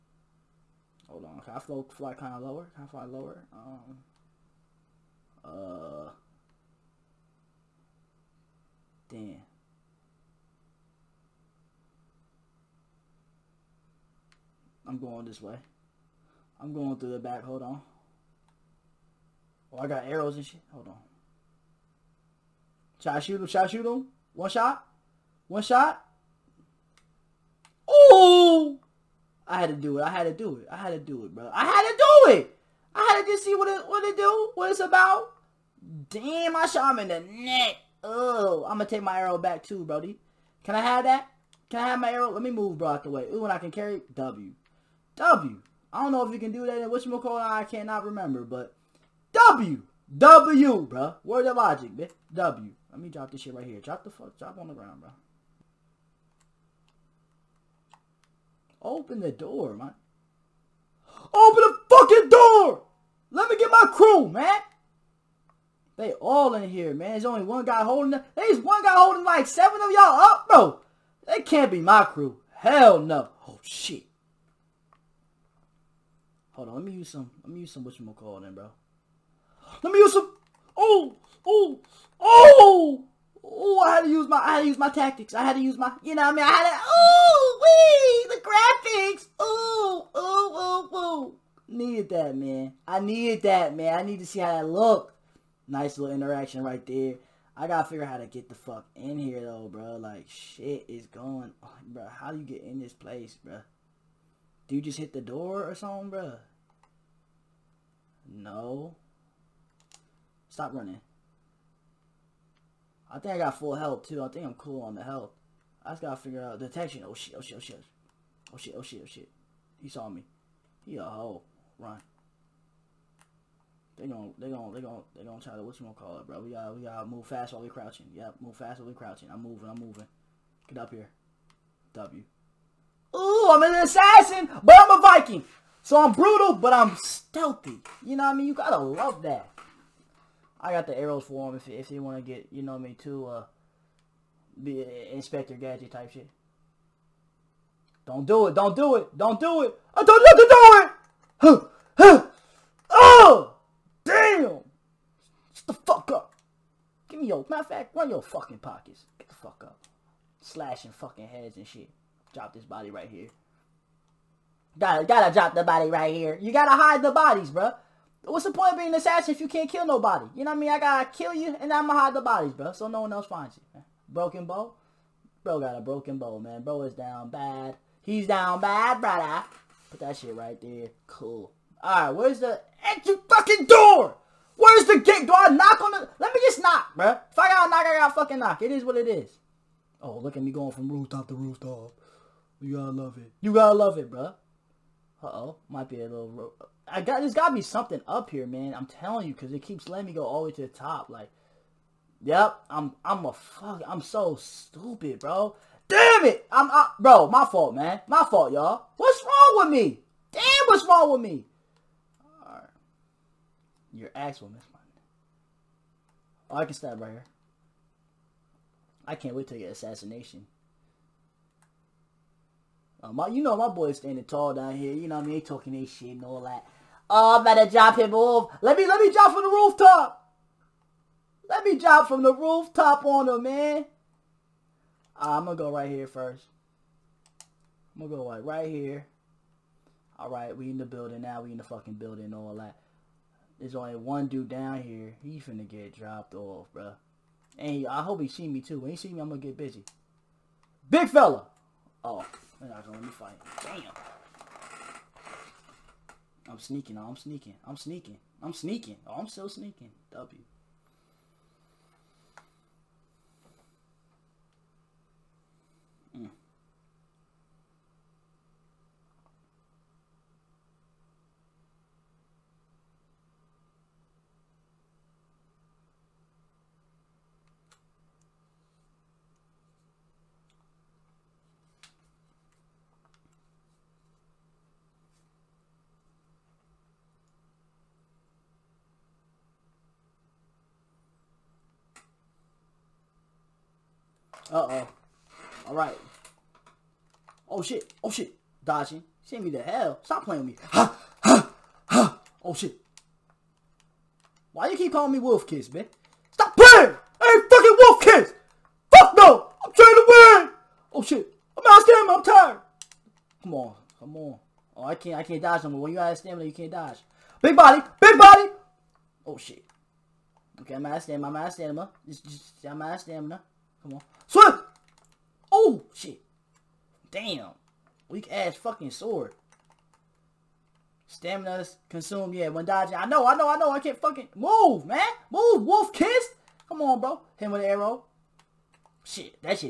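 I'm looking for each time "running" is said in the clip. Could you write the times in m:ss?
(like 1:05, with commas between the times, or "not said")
1:50.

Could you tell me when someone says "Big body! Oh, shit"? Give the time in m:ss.
5:17.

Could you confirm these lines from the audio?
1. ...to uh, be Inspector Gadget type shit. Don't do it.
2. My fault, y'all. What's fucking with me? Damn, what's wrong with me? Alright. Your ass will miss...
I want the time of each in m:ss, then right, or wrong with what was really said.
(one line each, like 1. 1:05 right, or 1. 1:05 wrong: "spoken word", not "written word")
1. 2:23 right
2. 3:28 wrong: "wrong", not "fucking".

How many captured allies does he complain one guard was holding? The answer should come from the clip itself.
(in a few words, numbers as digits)
7.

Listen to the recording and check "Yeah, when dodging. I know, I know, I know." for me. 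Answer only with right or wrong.
right.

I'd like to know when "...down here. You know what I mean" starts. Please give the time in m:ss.
3:44.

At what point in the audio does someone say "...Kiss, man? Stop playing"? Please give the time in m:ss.
5:05.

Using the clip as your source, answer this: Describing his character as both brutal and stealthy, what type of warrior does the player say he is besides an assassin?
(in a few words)
Viking.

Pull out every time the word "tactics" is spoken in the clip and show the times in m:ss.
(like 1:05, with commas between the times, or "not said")
1:24.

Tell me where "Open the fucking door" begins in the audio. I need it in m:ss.
1:01.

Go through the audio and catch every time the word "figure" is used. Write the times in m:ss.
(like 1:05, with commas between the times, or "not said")
1:37, 1:56.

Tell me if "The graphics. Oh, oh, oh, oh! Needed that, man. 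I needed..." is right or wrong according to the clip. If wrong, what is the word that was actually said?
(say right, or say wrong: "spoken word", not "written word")
right.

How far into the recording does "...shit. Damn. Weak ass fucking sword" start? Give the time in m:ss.
5:25.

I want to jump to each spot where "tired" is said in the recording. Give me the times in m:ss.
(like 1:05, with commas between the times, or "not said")
5:12.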